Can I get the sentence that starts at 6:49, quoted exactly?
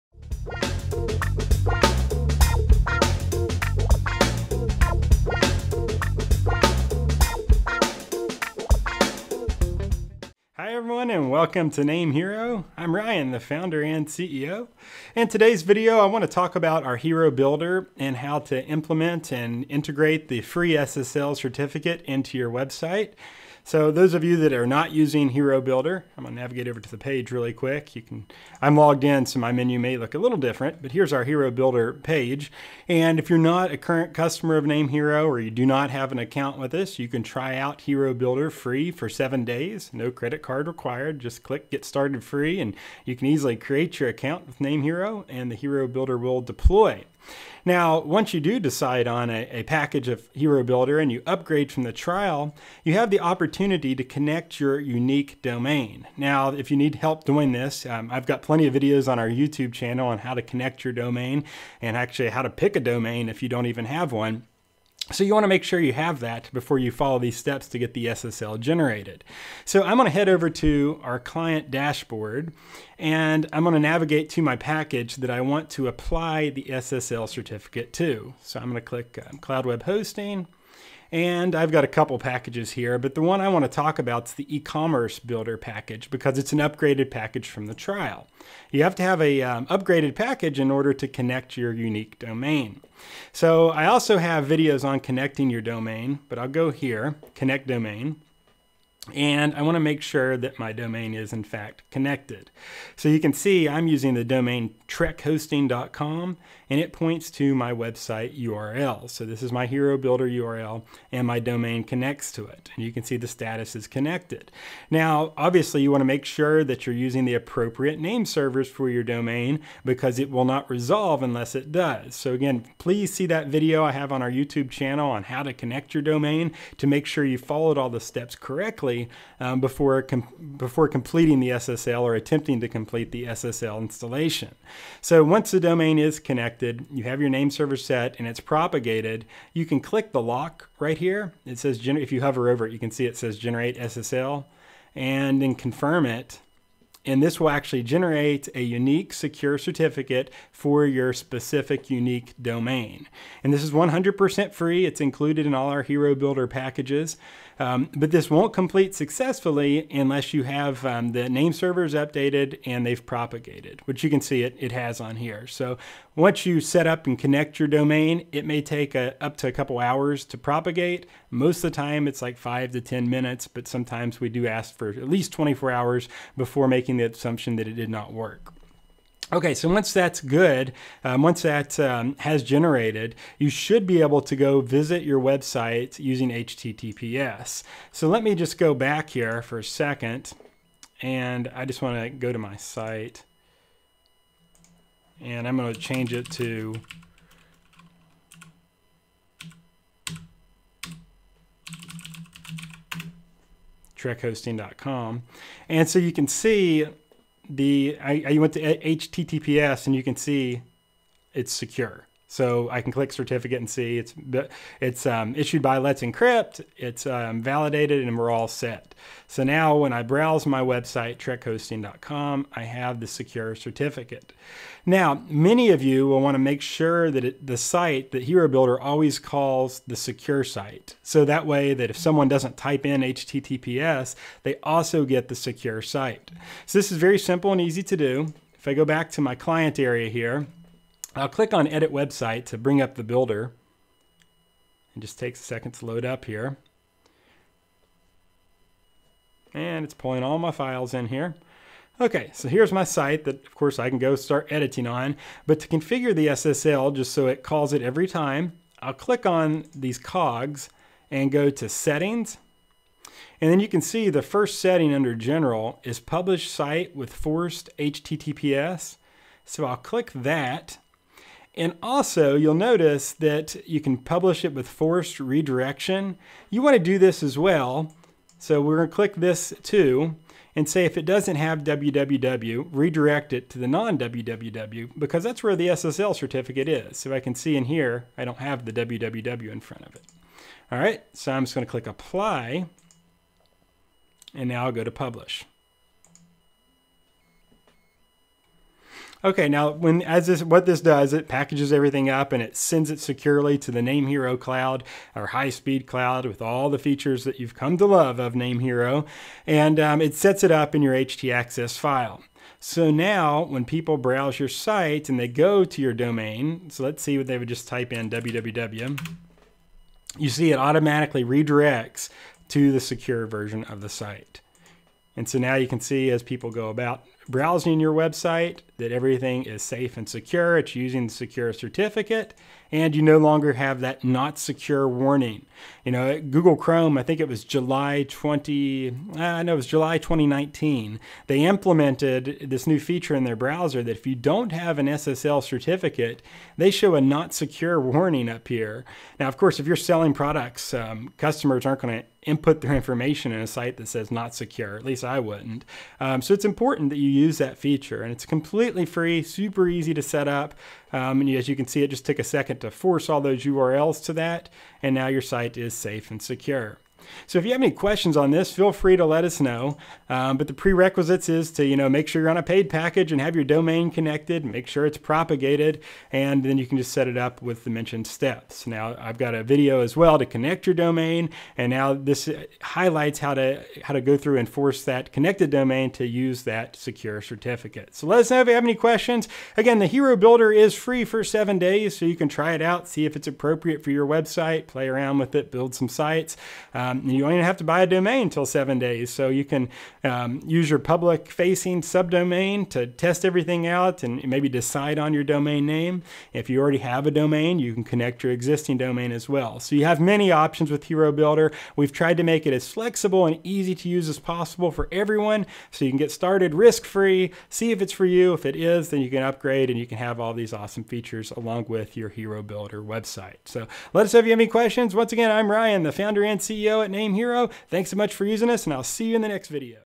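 So you have many options with Hero Builder.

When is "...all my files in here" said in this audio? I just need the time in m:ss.
4:10.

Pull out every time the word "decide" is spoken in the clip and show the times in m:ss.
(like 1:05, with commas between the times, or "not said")
0:48, 6:44.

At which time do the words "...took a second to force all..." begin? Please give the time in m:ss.
6:02.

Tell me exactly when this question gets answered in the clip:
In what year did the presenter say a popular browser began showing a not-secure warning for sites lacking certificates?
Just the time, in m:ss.
5:39.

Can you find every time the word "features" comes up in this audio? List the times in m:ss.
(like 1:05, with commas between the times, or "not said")
5:06, 5:42, 5:57, 7:00.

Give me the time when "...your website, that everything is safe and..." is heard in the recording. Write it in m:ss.
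5:27.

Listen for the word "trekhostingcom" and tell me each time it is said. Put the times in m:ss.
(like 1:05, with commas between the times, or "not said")
1:44, 3:23, 3:41.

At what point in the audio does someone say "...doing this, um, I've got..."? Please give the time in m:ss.
0:57.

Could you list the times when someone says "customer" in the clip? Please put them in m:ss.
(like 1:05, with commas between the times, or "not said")
0:34, 5:51.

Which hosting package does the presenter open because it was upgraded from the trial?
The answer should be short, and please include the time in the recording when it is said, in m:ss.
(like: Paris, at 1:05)
E-commerce builder package, at 1:24.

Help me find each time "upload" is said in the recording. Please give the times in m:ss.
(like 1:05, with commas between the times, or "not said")
not said.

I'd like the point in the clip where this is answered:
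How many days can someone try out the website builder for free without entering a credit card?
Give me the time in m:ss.
0:39.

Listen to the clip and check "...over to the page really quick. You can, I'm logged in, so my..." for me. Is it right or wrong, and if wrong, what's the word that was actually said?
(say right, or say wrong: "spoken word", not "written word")
right.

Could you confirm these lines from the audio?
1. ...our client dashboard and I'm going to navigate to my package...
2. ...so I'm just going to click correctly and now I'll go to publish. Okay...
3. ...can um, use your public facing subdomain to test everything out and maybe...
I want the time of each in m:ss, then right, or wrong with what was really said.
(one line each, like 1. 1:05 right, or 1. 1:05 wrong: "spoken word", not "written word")
1. 1:11 right
2. 4:51 wrong: "apply", not "correctly"
3. 6:39 right.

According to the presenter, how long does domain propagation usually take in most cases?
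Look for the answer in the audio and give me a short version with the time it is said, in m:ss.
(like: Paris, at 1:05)
5 to 10 minutes, at 2:52.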